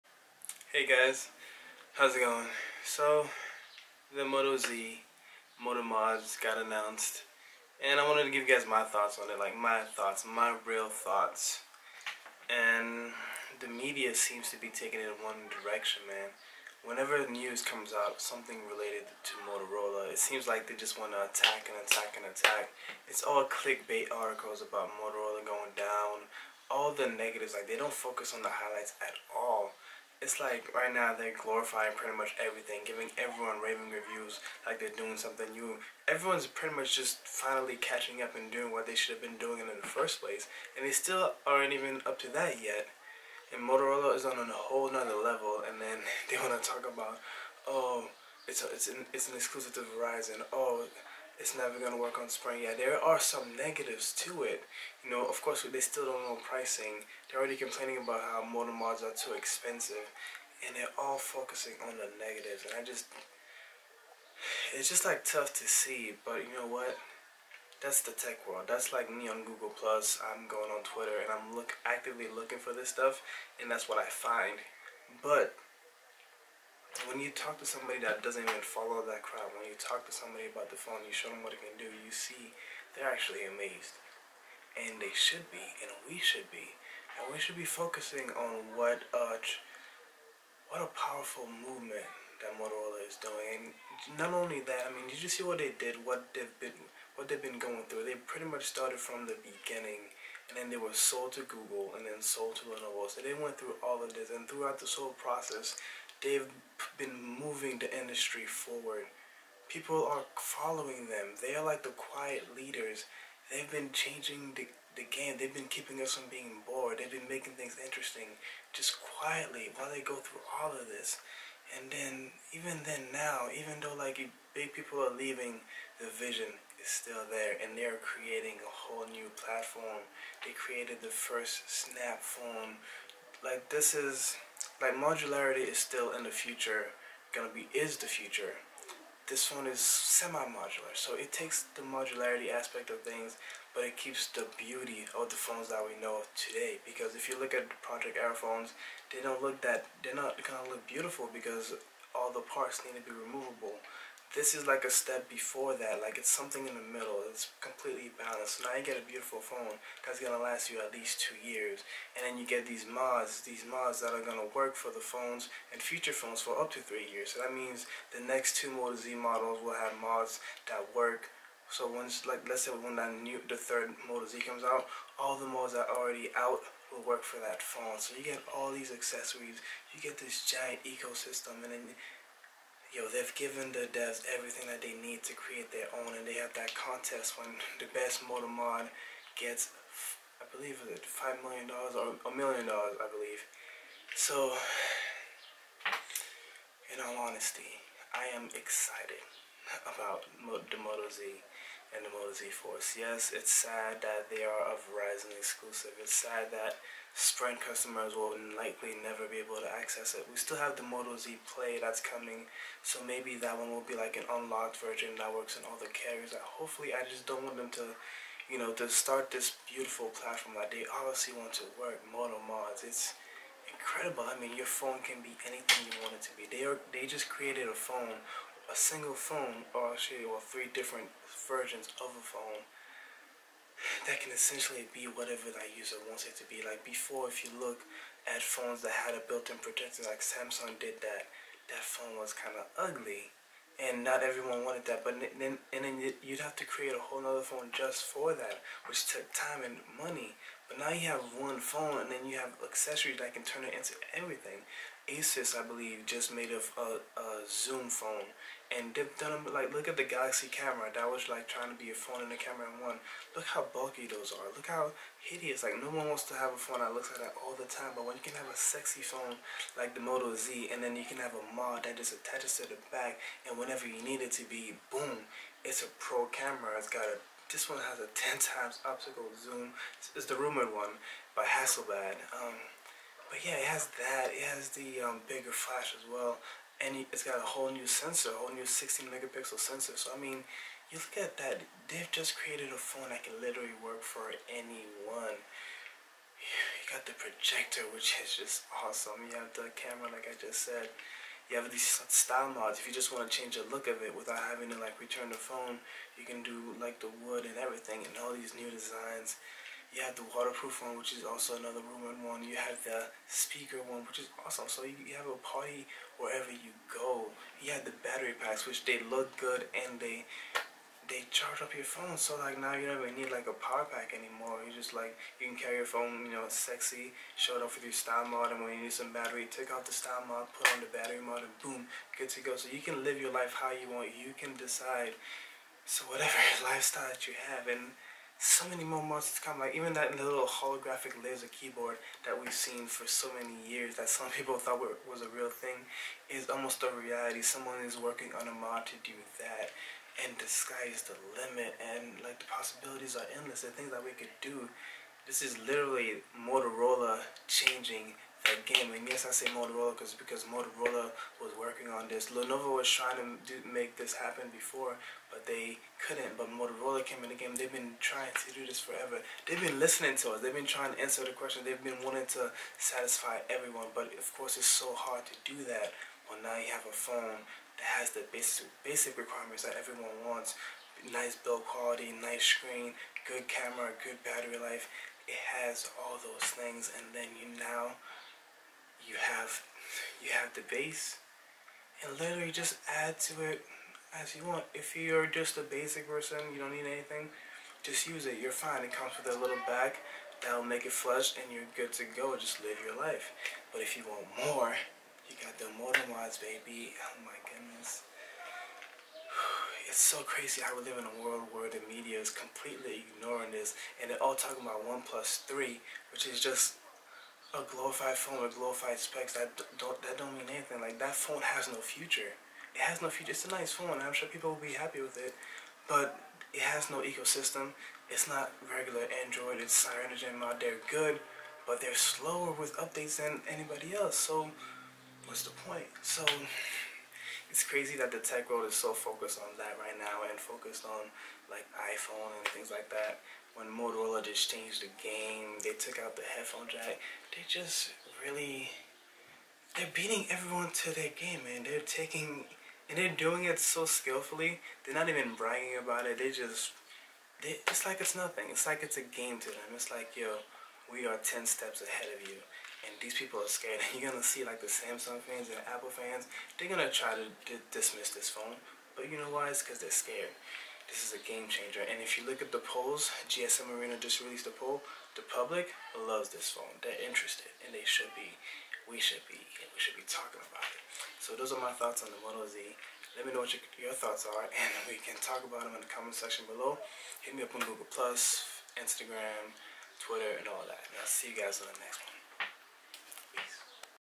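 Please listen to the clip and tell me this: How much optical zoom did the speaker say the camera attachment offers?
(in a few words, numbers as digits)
10 times.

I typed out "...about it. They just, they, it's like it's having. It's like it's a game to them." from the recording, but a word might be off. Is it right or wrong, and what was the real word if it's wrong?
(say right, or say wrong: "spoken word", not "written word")
wrong: "nothing", not "having".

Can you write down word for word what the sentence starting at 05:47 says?
Someone is working on a mod to do that, and the sky is the limit.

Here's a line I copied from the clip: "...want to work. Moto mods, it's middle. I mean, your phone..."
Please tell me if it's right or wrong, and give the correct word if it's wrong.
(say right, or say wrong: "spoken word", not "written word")
wrong: "incredible", not "middle".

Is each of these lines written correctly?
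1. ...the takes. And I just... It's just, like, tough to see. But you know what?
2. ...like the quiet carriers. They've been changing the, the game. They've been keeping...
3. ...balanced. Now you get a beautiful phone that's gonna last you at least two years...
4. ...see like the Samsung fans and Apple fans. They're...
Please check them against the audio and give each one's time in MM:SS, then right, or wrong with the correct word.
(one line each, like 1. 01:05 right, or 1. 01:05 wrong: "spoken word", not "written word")
1. 01:01 wrong: "negatives", not "takes"
2. 01:51 wrong: "leaders", not "carriers"
3. 02:38 right
4. 07:44 right.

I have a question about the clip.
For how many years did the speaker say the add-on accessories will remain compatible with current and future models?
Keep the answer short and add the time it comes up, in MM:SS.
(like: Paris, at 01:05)
3 years, at 02:46.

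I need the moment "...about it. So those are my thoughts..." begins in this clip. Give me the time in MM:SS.
08:00.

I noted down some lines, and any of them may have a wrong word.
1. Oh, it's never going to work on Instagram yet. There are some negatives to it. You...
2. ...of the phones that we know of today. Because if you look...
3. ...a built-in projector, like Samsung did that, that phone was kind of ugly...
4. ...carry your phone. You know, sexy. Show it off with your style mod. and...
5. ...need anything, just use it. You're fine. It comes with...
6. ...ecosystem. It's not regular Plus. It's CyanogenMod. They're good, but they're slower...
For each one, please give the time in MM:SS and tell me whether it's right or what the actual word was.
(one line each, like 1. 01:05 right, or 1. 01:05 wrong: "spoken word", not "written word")
1. 00:50 wrong: "Sprint", not "Instagram"
2. 02:25 right
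3. 03:59 right
4. 05:25 right
5. 06:36 right
6. 07:07 wrong: "Android", not "Plus".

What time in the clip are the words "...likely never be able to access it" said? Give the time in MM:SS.
03:28.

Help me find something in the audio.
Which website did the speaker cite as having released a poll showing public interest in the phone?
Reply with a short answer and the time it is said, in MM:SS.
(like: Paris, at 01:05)
GSM Arena, at 07:53.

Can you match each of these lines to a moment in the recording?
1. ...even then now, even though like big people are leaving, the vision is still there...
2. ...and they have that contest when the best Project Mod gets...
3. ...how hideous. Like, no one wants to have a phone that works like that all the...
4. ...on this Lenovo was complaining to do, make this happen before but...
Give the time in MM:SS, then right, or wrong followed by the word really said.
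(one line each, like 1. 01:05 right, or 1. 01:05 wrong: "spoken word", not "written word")
1. 02:02 right
2. 03:06 wrong: "Moto", not "Project"
3. 04:24 wrong: "looks", not "works"
4. 06:01 wrong: "trying", not "complaining".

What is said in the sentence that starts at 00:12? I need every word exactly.
And the media seems to be taking it in one direction, man.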